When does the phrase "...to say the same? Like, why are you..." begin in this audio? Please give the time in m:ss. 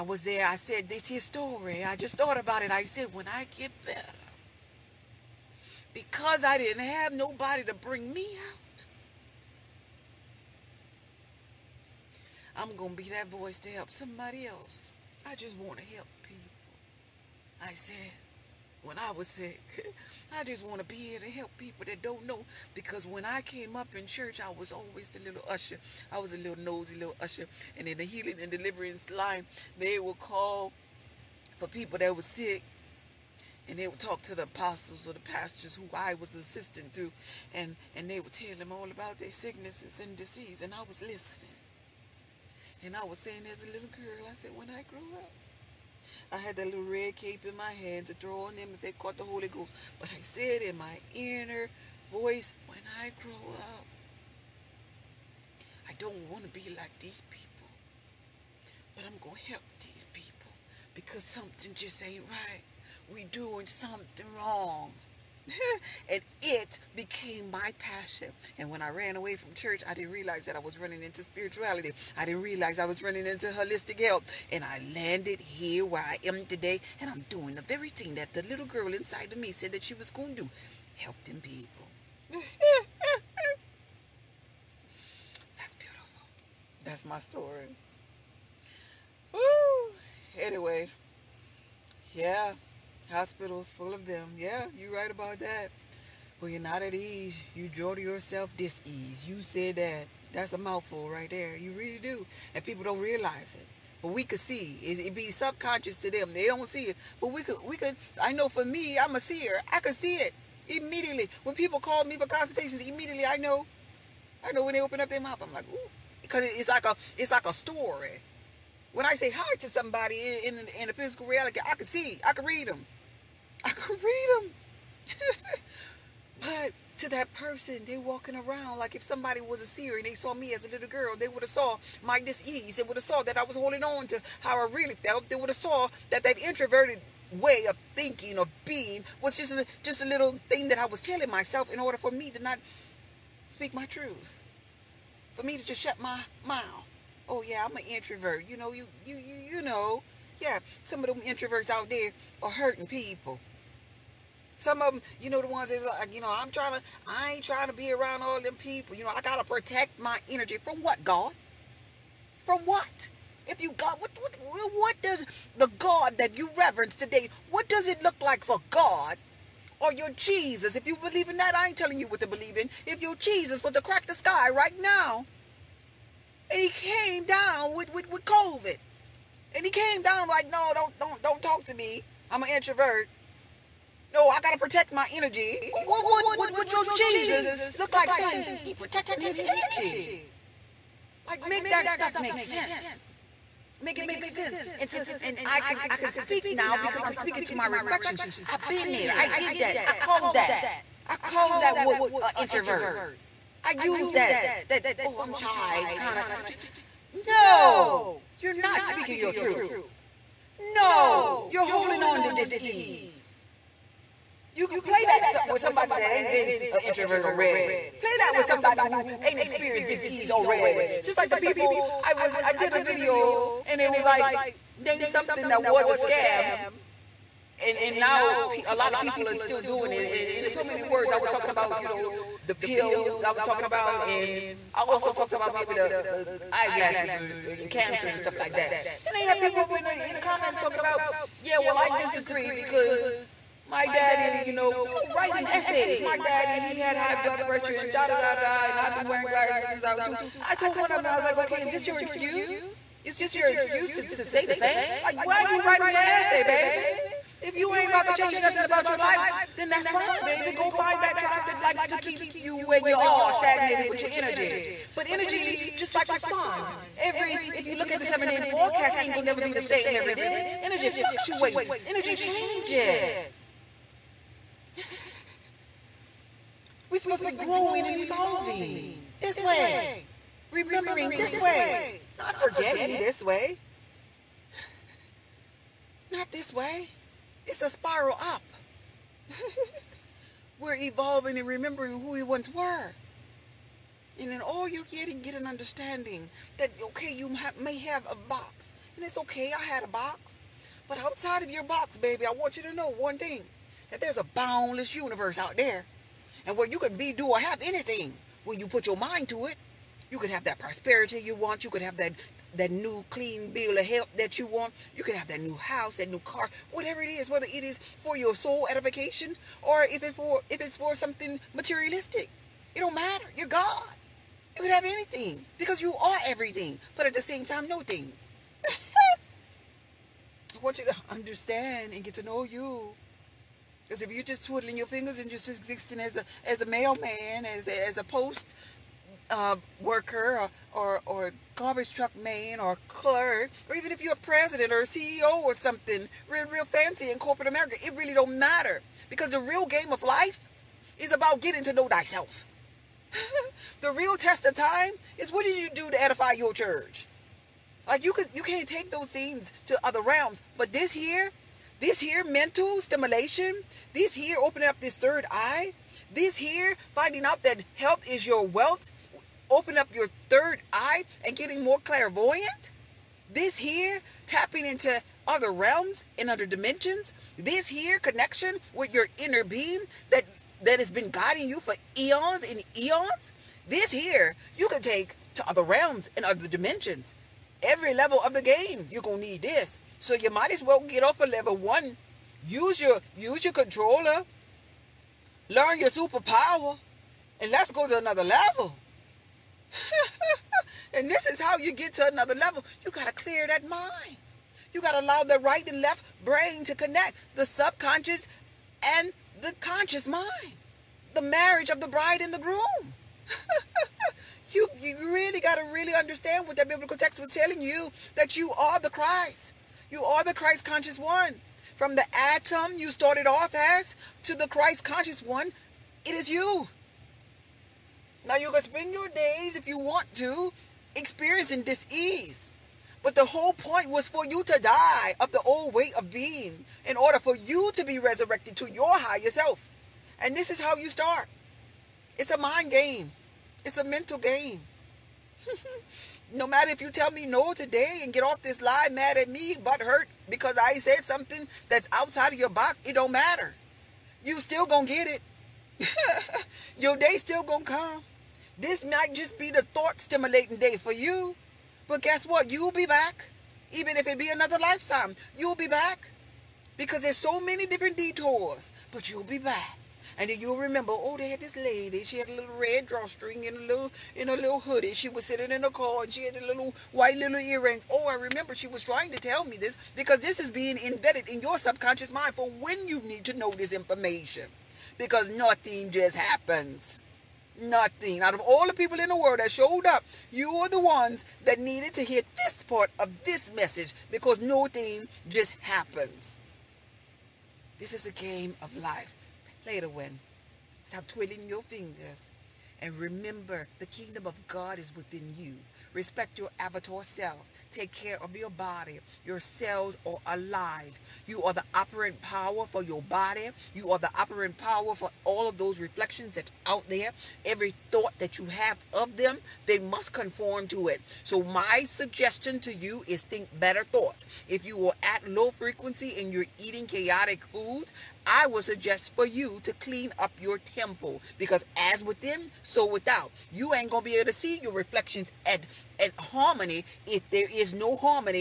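4:14.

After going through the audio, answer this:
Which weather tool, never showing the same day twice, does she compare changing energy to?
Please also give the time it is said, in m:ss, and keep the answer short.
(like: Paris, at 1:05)
seven day forecast, at 4:28.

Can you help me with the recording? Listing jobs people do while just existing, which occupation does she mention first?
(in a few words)
mailman.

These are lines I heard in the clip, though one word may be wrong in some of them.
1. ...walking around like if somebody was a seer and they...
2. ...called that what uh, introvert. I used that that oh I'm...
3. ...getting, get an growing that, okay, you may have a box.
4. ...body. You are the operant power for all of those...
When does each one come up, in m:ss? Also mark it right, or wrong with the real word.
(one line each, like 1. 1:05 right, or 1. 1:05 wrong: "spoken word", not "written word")
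1. 2:07 right
2. 3:21 right
3. 4:54 wrong: "understanding", not "growing"
4. 8:33 right.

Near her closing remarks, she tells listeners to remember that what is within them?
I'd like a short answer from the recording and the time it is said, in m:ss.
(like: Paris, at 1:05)
the kingdom of God, at 8:23.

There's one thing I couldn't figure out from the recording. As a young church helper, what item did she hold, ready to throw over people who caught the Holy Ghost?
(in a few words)
red cape.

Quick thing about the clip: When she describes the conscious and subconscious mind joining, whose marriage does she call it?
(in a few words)
the bride and the groom.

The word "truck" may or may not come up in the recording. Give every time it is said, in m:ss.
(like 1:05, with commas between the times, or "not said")
5:41.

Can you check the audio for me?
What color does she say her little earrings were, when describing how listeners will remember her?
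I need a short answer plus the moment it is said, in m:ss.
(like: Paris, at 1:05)
white, at 7:56.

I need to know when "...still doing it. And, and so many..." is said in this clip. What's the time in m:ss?
3:49.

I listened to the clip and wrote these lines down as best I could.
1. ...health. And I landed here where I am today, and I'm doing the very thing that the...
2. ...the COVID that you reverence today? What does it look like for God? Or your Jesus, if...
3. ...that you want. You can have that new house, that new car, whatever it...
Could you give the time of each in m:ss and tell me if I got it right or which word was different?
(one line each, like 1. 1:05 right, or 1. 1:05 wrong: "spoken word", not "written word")
1. 1:14 right
2. 2:45 wrong: "God", not "COVID"
3. 5:14 right.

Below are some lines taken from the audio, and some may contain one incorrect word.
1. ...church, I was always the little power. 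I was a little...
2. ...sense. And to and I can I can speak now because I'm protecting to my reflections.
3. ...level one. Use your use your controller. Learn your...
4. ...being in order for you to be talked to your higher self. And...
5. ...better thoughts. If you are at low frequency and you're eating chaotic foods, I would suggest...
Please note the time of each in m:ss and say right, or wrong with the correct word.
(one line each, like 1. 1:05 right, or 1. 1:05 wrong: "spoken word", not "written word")
1. 0:24 wrong: "usher", not "power"
2. 3:14 wrong: "speaking", not "protecting"
3. 6:31 right
4. 7:16 wrong: "resurrected", not "talked"
5. 8:43 right.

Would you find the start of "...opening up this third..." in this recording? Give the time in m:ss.
6:04.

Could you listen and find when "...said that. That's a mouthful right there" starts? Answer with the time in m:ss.
1:39.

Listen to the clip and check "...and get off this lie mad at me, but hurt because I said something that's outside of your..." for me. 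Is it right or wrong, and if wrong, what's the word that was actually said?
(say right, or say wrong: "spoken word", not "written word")
right.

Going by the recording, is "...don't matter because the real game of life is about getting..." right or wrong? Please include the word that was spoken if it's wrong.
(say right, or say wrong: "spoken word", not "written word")
right.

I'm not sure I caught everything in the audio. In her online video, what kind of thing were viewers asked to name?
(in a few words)
a scam.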